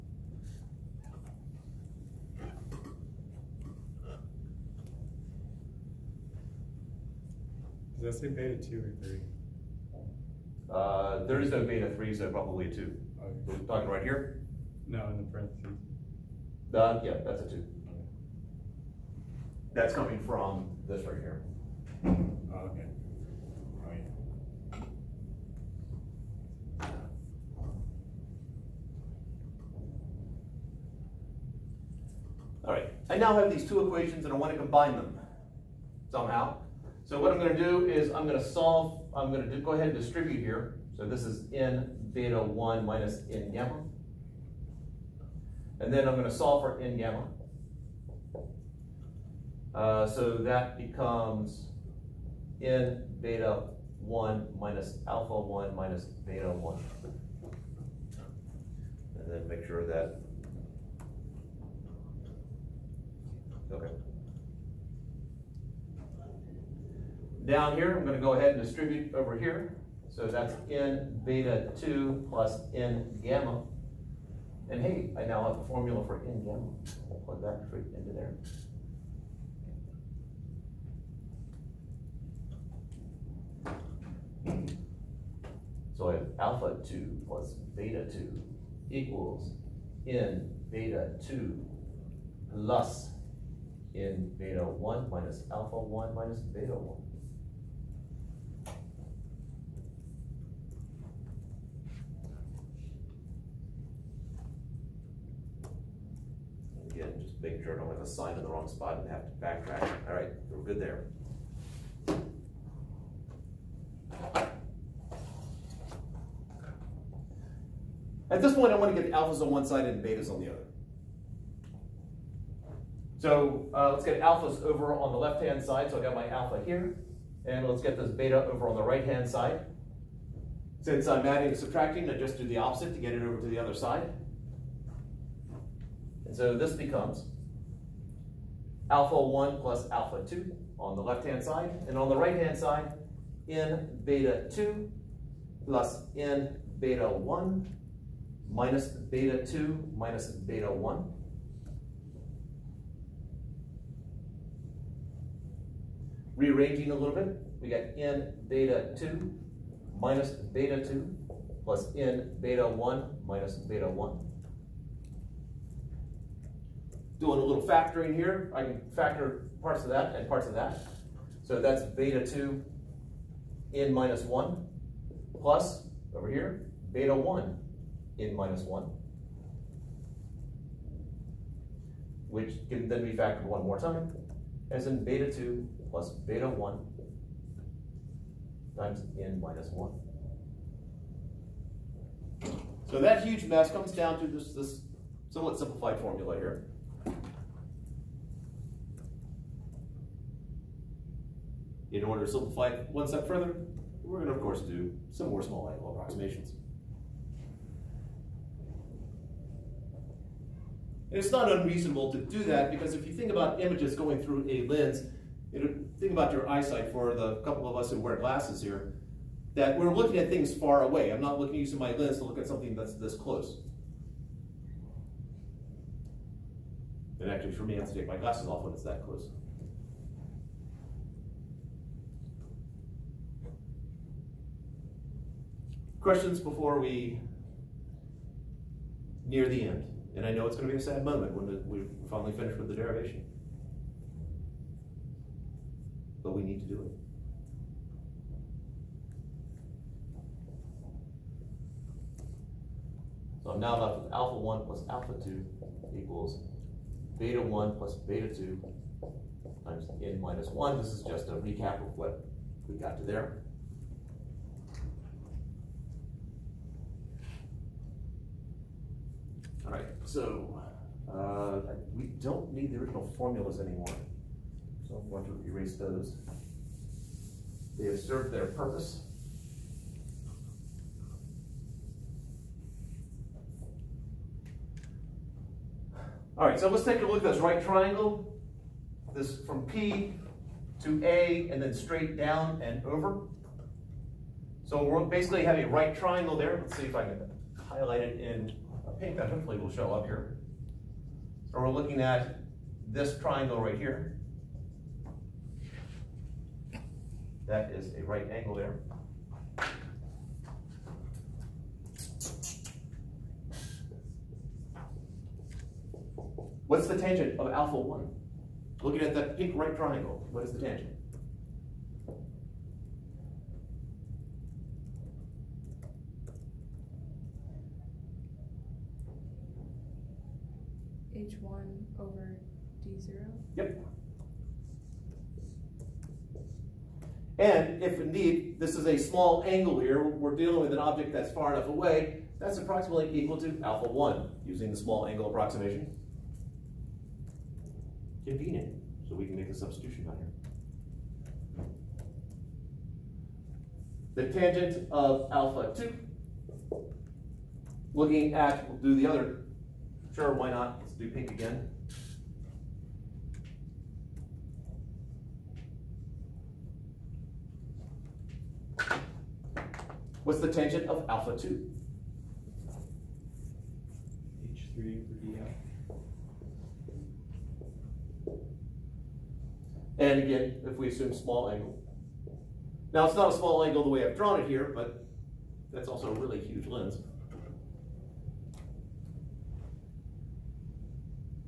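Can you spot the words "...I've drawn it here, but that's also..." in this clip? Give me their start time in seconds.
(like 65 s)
384 s.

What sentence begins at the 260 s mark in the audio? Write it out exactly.
This is just a recap of what we got to there.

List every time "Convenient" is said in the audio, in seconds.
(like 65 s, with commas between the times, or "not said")
348 s.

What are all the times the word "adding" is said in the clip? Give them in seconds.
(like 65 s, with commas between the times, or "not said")
131 s.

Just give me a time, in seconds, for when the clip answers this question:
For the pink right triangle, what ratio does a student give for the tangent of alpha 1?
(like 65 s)
331 s.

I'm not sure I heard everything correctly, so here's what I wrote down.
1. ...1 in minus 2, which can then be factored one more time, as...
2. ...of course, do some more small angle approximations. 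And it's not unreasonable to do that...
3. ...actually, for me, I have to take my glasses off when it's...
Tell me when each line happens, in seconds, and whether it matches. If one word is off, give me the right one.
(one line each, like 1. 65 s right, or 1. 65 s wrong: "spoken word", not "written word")
1. 177 s wrong: "1", not "2"
2. 204 s right
3. 227 s right.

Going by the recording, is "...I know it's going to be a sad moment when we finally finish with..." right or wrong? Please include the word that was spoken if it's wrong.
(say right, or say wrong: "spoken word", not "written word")
right.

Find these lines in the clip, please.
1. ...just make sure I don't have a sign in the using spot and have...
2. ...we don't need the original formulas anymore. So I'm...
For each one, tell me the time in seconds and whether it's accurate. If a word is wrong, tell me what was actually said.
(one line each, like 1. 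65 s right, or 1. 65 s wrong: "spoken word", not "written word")
1. 107 s wrong: "wrong", not "using"
2. 271 s right.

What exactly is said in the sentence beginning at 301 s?
So we're looking at this triangle right here.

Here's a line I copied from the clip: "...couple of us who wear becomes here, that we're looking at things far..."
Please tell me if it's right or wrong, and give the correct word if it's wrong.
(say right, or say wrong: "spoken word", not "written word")
wrong: "glasses", not "becomes".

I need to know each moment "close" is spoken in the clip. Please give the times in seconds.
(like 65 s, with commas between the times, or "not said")
223 s, 229 s.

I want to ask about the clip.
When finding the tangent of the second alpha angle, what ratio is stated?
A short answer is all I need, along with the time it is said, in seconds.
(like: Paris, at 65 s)
H3 over dl, at 374 s.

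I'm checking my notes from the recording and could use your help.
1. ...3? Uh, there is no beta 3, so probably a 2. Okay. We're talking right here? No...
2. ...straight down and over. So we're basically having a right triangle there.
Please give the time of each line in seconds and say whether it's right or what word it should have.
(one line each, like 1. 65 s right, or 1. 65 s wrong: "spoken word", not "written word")
1. 9 s right
2. 291 s right.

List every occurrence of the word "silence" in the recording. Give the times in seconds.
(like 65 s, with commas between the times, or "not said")
not said.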